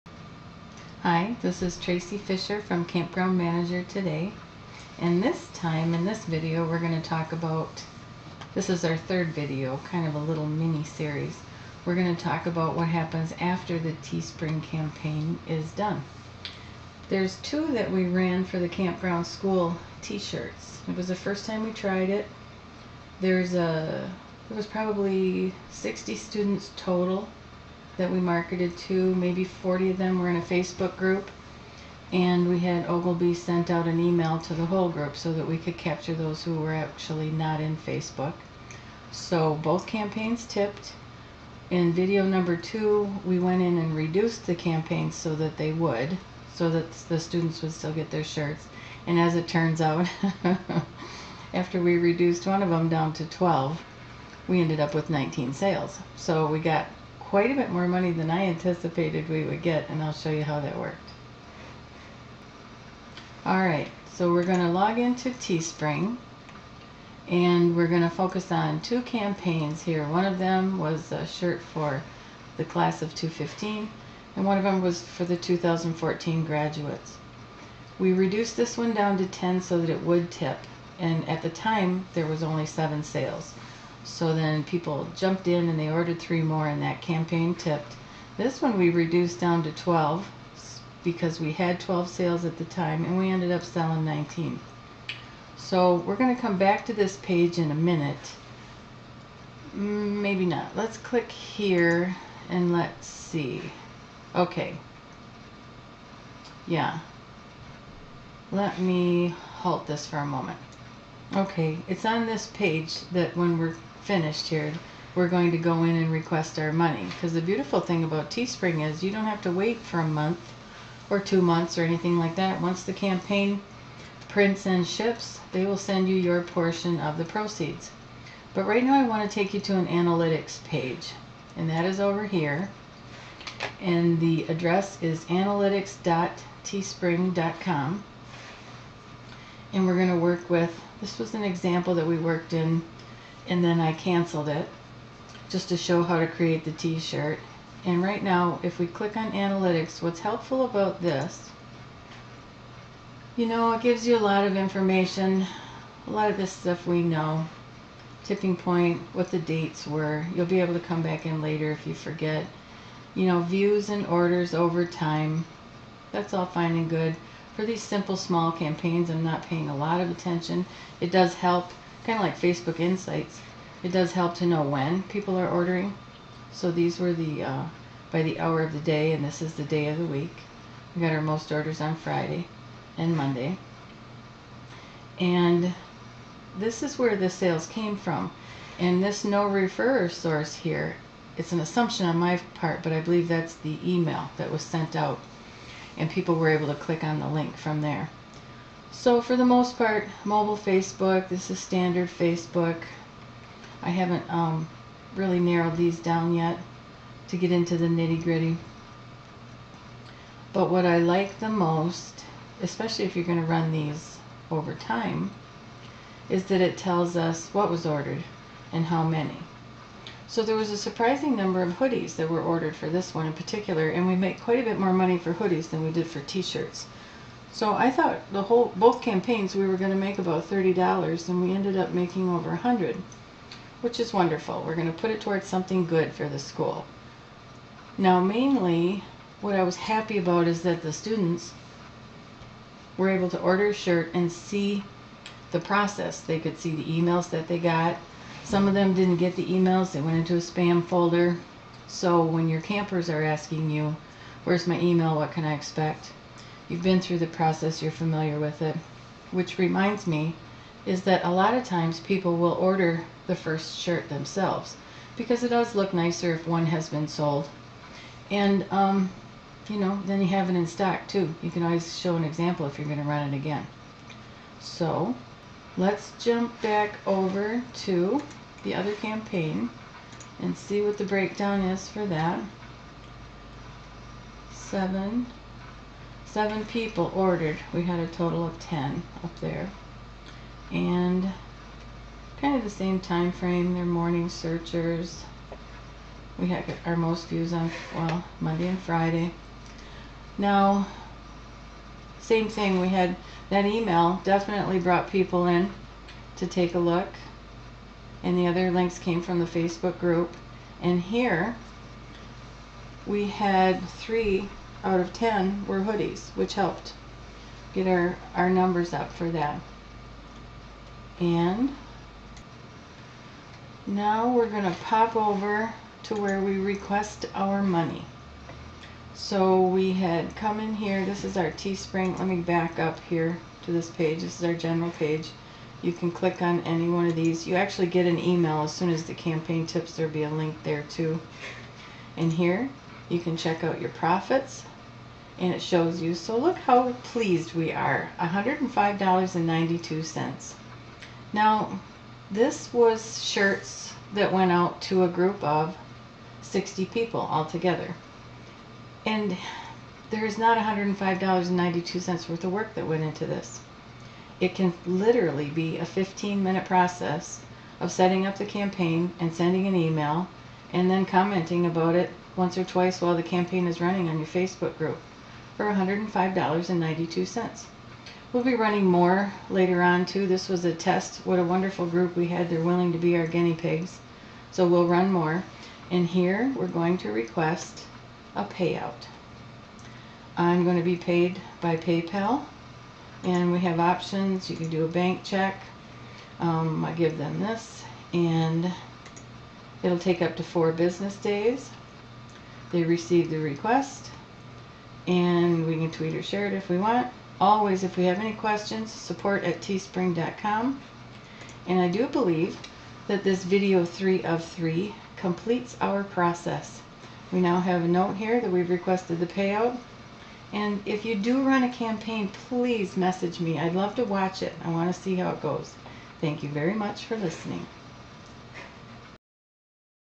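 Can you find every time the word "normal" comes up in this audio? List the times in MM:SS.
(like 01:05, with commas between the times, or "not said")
not said.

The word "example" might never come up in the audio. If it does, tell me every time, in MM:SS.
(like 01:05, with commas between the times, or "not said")
02:21, 04:32.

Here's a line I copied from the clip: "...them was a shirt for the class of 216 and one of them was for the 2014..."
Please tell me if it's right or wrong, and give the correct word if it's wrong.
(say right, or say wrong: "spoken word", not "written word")
wrong: "215", not "216".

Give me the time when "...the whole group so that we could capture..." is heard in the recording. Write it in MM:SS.
00:34.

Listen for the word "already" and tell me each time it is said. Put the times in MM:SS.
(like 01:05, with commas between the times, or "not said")
not said.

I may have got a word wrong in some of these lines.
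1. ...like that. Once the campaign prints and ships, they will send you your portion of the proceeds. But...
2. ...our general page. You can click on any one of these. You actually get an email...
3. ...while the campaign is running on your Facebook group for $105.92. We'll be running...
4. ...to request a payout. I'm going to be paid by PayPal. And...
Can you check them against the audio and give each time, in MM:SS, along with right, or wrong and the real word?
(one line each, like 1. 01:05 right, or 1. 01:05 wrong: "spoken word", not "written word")
1. 02:02 right
2. 05:34 right
3. 06:13 right
4. 06:26 right.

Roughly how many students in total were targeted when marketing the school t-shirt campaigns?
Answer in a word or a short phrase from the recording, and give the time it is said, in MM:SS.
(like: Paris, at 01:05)
60, at 00:24.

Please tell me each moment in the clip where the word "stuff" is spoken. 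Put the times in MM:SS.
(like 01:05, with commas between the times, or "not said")
02:36.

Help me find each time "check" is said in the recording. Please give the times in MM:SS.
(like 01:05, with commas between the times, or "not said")
05:43, 06:35.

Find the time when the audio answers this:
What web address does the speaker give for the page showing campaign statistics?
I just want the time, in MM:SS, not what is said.
02:15.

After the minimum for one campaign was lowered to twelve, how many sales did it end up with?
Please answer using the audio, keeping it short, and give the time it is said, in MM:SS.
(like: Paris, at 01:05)
19, at 00:54.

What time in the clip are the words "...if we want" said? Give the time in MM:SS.
06:46.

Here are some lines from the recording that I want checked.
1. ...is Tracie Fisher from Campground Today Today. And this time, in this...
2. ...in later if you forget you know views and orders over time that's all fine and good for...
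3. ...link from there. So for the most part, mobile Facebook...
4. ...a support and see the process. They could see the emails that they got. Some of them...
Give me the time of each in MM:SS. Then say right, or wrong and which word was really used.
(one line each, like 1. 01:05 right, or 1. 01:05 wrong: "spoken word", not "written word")
1. 00:01 wrong: "Manager", not "Today"
2. 02:41 right
3. 03:17 right
4. 04:03 wrong: "shirt", not "support".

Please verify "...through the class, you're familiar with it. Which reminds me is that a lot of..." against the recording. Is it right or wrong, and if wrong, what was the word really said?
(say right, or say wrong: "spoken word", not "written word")
wrong: "process", not "class".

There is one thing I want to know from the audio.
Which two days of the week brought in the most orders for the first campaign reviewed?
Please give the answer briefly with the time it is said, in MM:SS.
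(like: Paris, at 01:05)
Friday and Monday, at 03:01.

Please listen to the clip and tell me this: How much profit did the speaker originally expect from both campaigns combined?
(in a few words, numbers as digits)
$30.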